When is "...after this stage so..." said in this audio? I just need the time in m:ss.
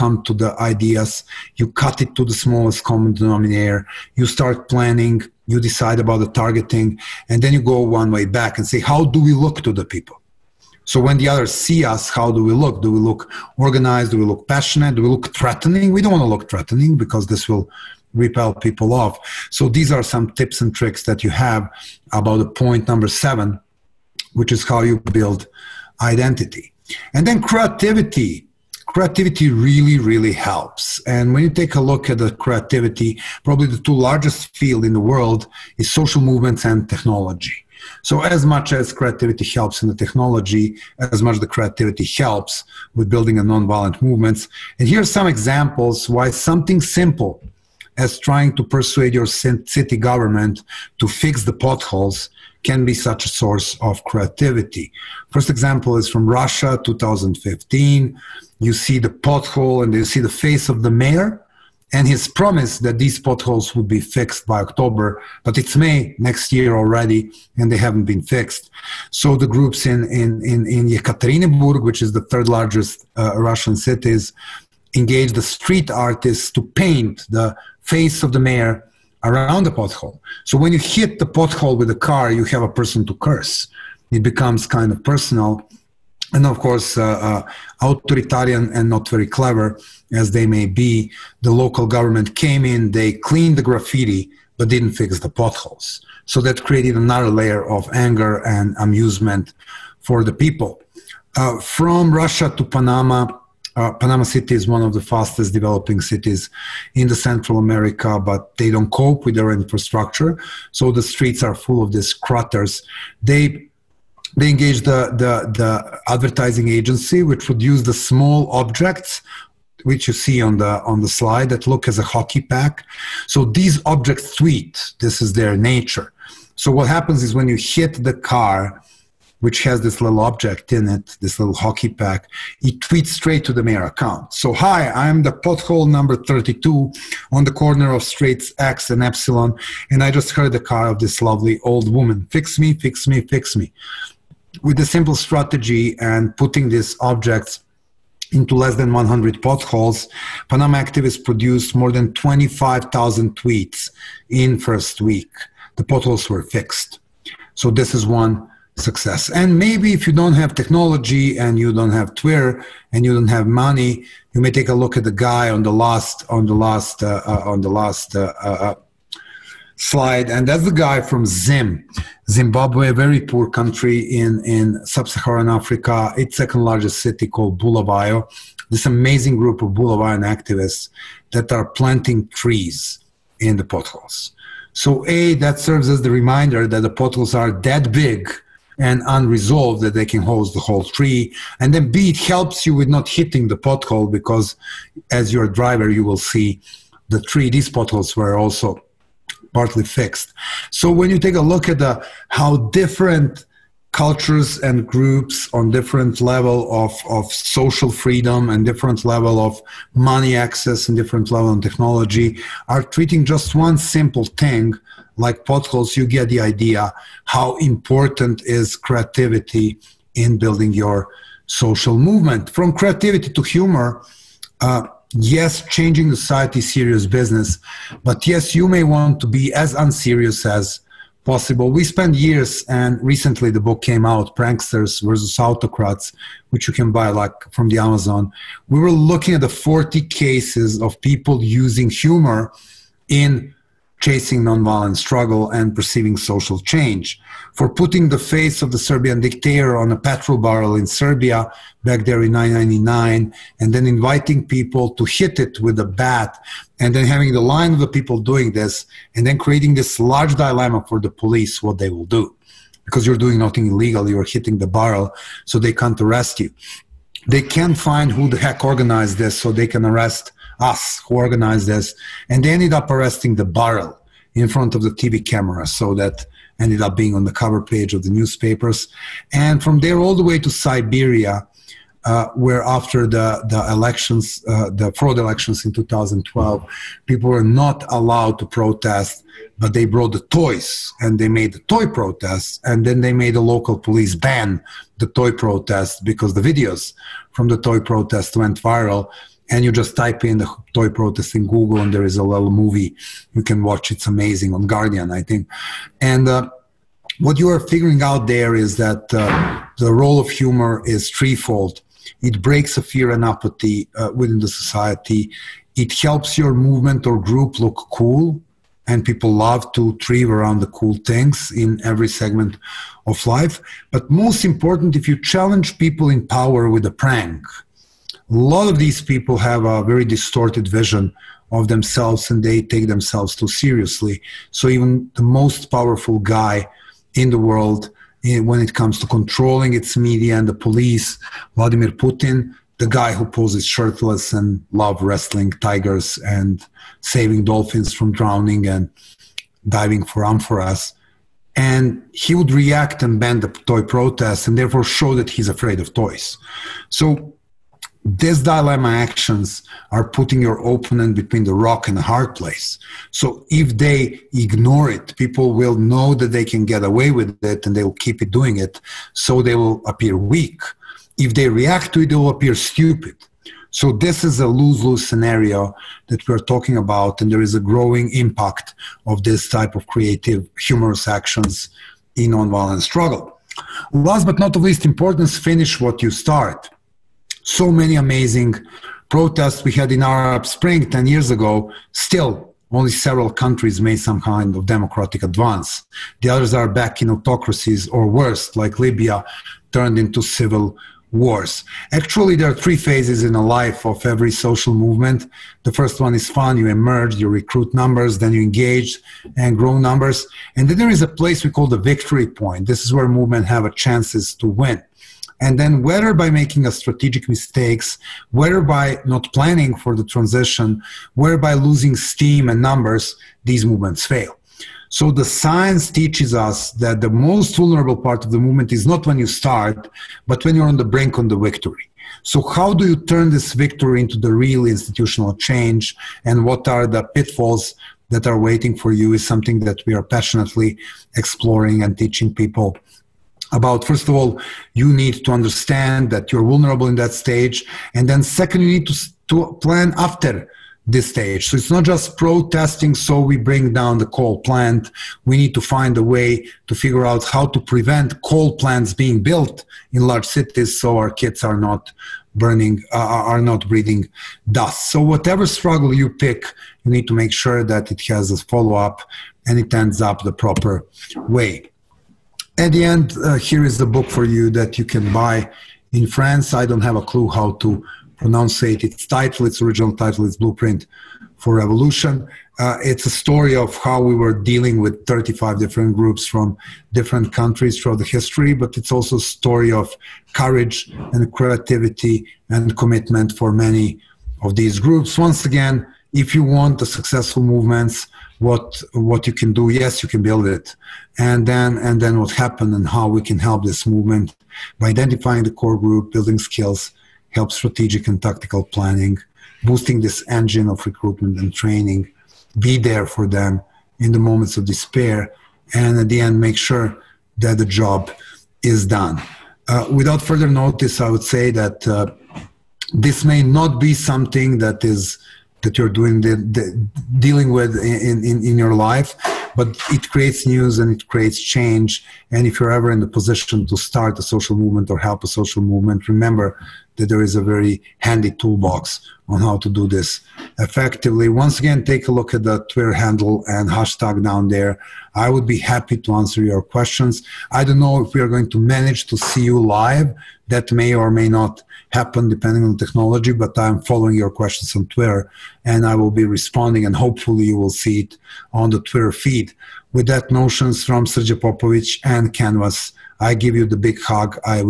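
7:29.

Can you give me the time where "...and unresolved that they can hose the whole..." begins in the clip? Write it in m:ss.
3:08.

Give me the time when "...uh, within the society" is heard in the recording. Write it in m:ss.
5:13.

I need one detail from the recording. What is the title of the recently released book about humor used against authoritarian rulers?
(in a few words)
Pranksters versus Autocrats.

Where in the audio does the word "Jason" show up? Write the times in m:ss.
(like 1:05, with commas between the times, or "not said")
not said.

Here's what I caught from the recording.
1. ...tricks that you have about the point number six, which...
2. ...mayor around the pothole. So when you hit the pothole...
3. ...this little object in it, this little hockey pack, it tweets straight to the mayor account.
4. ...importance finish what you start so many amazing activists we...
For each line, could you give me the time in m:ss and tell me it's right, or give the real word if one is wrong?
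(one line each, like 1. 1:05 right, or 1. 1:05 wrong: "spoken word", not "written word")
1. 0:20 wrong: "seven", not "six"
2. 1:18 right
3. 2:09 right
4. 6:24 wrong: "protests", not "activists".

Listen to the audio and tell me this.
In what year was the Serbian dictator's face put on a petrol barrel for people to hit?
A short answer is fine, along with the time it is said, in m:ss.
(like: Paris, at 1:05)
1999, at 4:12.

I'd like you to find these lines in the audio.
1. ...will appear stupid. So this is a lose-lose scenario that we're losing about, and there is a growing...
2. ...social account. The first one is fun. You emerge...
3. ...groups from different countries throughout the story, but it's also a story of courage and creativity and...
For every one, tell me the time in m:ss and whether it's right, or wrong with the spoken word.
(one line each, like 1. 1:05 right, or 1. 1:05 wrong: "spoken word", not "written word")
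1. 6:12 wrong: "talking", not "losing"
2. 6:44 wrong: "movement", not "account"
3. 8:05 wrong: "history", not "story".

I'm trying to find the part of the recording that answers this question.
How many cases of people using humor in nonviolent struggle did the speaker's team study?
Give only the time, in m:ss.
3:59.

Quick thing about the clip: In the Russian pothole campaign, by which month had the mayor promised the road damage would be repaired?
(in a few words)
October.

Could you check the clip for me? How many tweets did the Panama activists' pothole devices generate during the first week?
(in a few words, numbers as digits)
25,000.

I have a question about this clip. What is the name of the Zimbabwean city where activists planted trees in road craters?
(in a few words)
Bulawayo.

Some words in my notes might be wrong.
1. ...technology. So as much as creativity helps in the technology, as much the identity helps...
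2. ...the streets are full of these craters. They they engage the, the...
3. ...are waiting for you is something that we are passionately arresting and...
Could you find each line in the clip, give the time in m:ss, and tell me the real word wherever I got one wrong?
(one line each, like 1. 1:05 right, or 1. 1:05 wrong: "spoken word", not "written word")
1. 0:36 wrong: "creativity", not "identity"
2. 1:50 right
3. 7:18 wrong: "exploring", not "arresting".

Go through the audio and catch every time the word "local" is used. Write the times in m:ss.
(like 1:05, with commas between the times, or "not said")
1:31, 4:53.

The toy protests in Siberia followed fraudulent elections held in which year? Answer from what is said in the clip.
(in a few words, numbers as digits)
2012.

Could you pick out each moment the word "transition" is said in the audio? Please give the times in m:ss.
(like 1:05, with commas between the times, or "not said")
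7:00.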